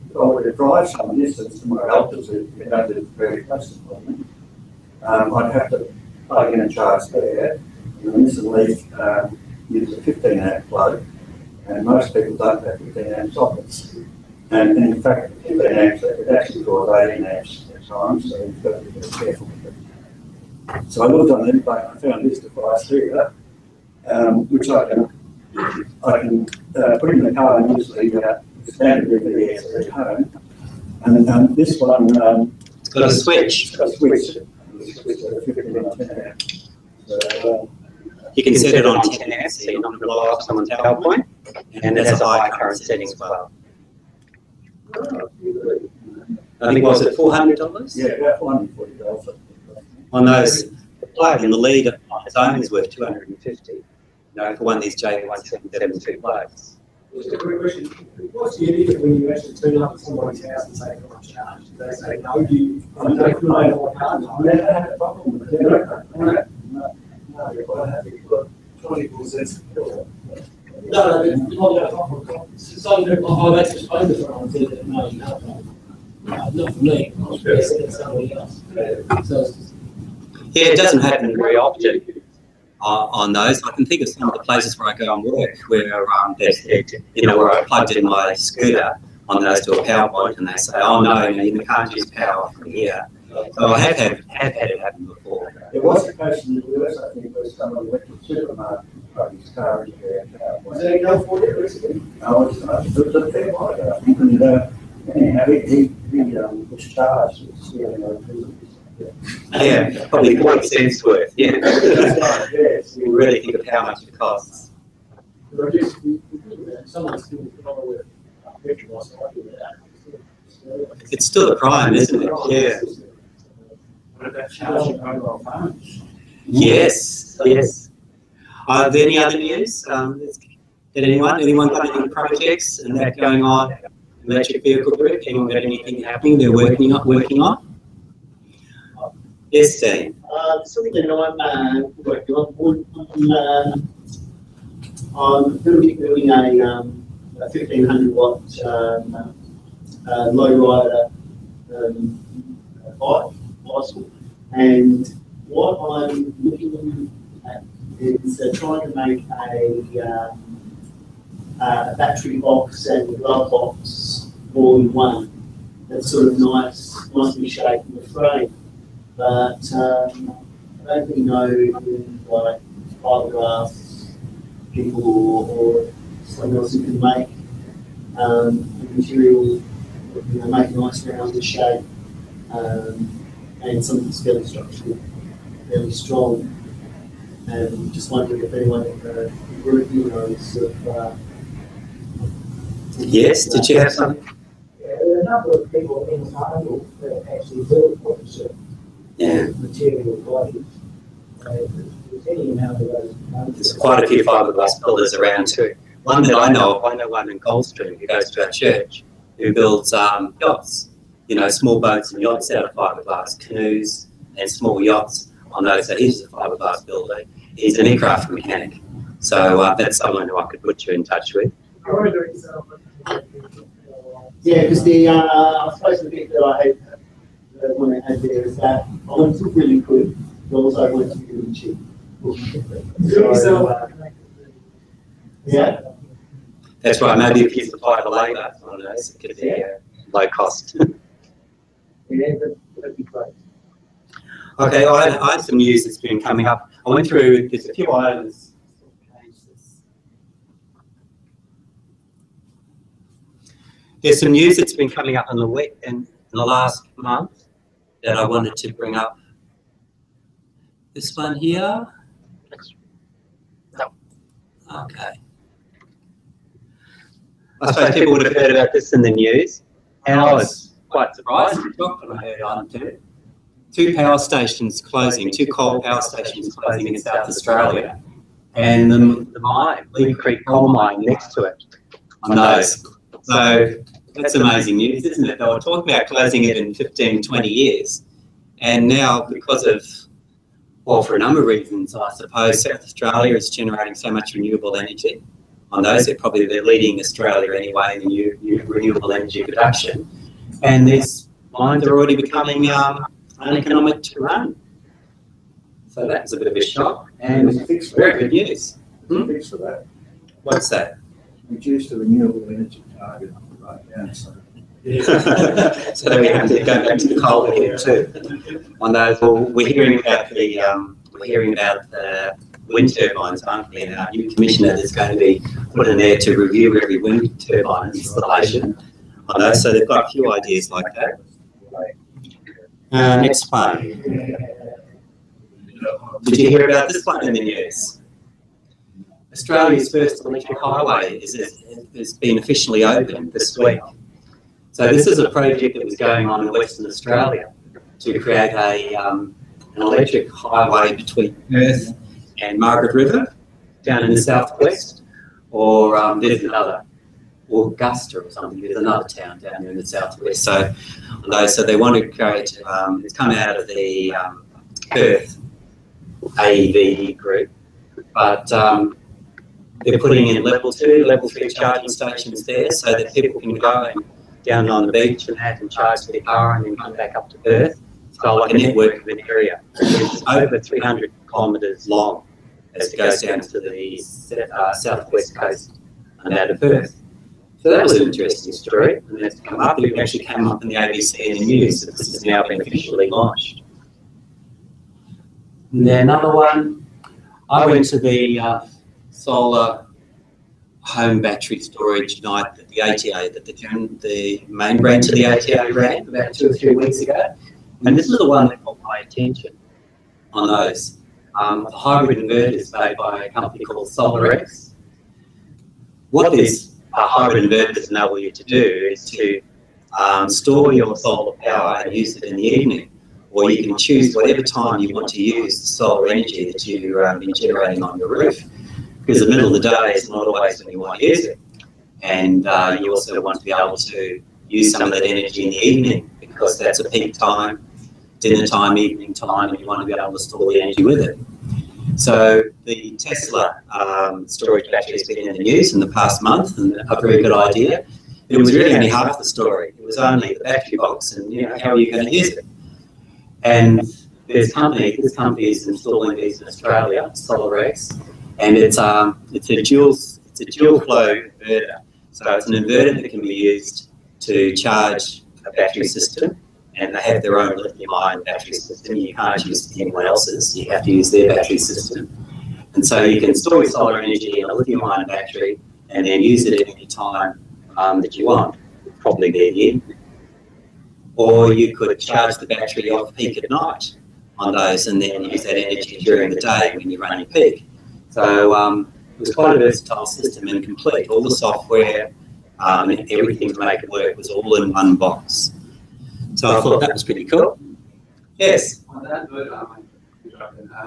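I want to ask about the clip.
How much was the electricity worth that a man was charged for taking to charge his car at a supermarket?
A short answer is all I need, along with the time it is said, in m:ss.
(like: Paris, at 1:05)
40 cents, at 1:50.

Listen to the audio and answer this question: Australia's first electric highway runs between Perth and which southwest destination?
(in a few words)
Margaret River.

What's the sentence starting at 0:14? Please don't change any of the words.
And, and in fact, 15 amps, it actually draws 18 amps at times, so you've got to be careful with it.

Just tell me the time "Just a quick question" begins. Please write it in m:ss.
0:57.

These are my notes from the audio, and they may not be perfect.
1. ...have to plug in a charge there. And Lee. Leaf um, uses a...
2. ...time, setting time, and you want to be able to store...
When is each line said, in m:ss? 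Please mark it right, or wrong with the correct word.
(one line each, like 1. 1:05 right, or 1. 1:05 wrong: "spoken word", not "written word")
1. 0:05 wrong: "Mrs", not "Lee"
2. 7:18 wrong: "evening", not "setting".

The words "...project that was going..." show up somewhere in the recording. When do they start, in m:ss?
5:45.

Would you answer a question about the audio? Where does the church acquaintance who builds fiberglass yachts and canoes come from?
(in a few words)
Goldstream.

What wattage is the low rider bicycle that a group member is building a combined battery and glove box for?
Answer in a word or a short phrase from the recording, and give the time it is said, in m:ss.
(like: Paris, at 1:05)
1500 watt, at 2:25.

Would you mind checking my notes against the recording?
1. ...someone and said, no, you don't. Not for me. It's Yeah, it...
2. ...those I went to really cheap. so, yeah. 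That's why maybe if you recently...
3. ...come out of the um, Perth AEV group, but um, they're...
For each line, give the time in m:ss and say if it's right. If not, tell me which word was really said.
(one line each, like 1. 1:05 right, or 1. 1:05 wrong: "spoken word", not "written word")
1. 1:14 right
2. 3:50 wrong: "supply", not "recently"
3. 6:03 right.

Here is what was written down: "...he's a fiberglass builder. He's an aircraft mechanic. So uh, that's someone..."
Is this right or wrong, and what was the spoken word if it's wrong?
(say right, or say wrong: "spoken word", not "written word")
right.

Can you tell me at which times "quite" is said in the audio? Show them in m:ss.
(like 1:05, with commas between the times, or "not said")
1:07, 3:23, 4:30, 8:09.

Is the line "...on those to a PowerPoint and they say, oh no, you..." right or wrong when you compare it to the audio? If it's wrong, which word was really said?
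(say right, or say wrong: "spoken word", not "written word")
right.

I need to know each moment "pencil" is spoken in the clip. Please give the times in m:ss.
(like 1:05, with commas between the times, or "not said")
not said.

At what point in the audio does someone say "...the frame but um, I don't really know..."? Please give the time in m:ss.
2:47.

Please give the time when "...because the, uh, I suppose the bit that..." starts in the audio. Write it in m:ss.
3:44.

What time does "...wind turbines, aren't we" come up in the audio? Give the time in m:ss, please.
5:22.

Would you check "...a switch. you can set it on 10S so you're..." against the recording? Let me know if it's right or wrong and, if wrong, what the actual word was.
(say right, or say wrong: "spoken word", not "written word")
right.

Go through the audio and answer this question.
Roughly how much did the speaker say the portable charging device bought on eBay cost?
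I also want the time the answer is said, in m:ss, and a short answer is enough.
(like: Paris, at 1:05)
$440, at 0:48.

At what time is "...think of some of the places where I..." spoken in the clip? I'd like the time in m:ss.
1:23.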